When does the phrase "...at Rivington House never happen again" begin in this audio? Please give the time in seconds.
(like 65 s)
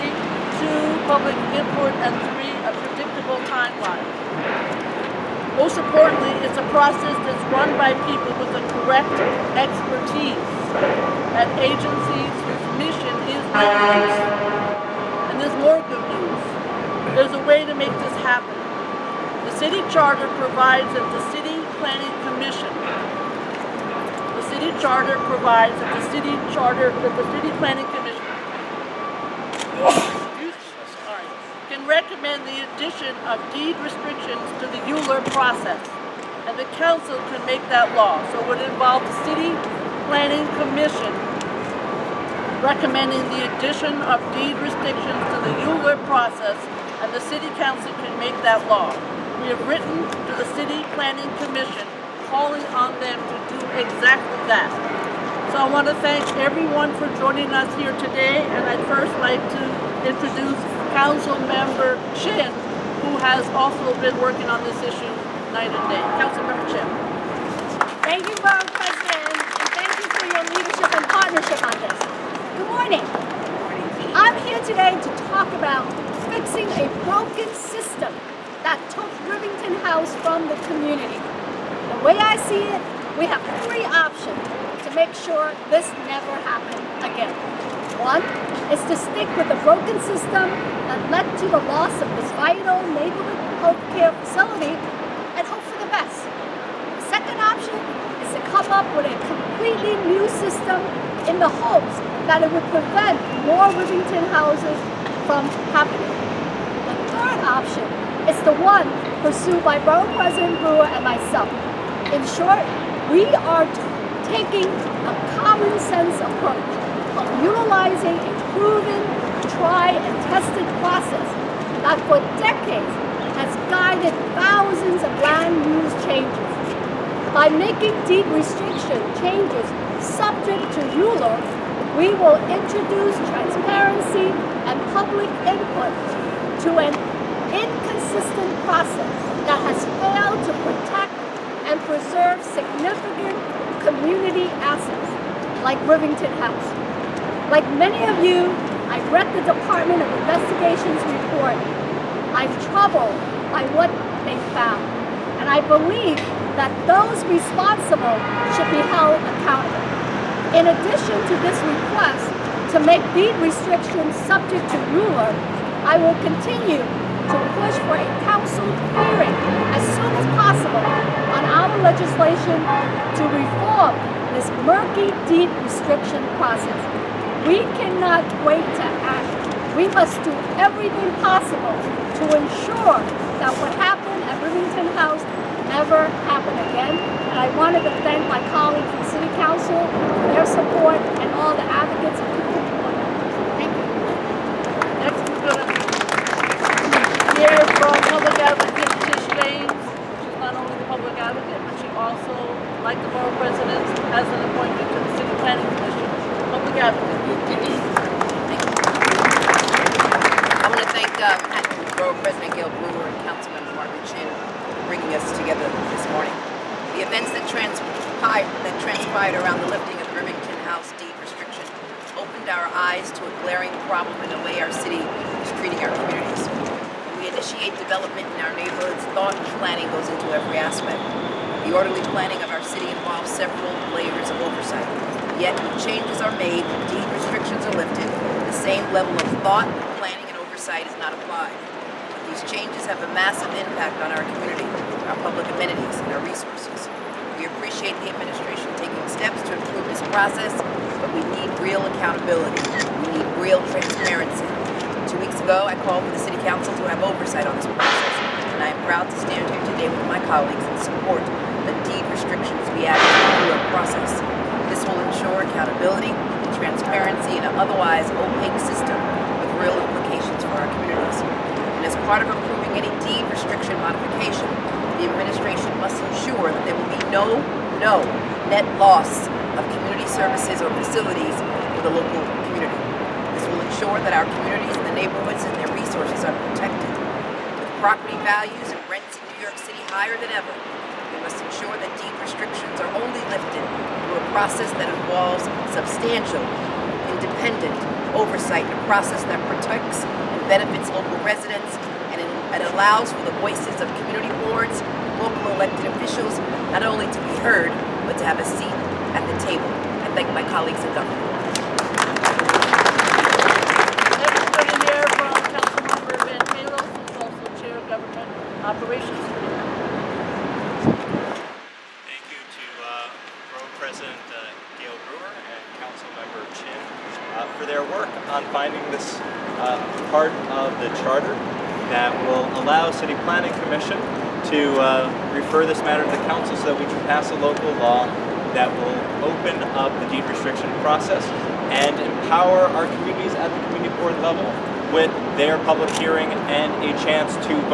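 184 s.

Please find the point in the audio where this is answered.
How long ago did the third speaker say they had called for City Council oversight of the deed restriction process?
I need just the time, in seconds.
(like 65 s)
255 s.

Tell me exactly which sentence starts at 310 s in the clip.
I thank my colleagues in government.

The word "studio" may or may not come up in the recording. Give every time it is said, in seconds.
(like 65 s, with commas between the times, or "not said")
not said.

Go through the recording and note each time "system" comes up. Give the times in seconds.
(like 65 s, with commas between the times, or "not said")
77 s, 90 s, 100 s, 268 s.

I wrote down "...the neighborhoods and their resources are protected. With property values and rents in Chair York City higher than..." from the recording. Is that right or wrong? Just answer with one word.
wrong.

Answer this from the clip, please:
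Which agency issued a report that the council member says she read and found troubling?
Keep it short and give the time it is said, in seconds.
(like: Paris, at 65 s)
Department of Investigations, at 149 s.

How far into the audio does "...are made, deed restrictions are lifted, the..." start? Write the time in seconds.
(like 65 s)
236 s.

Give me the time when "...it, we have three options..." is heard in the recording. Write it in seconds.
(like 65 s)
82 s.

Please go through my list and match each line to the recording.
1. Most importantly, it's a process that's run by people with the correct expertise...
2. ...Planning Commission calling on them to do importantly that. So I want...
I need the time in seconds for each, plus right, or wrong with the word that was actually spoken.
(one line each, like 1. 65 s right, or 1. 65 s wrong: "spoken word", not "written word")
1. 5 s right
2. 50 s wrong: "exactly", not "importantly".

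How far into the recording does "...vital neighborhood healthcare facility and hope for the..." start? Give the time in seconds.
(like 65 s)
92 s.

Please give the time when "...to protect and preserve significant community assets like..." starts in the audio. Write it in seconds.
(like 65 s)
140 s.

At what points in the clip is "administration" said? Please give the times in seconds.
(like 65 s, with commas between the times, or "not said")
248 s, 275 s.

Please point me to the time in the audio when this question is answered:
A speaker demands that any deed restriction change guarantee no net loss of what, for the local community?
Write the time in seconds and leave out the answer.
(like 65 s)
279 s.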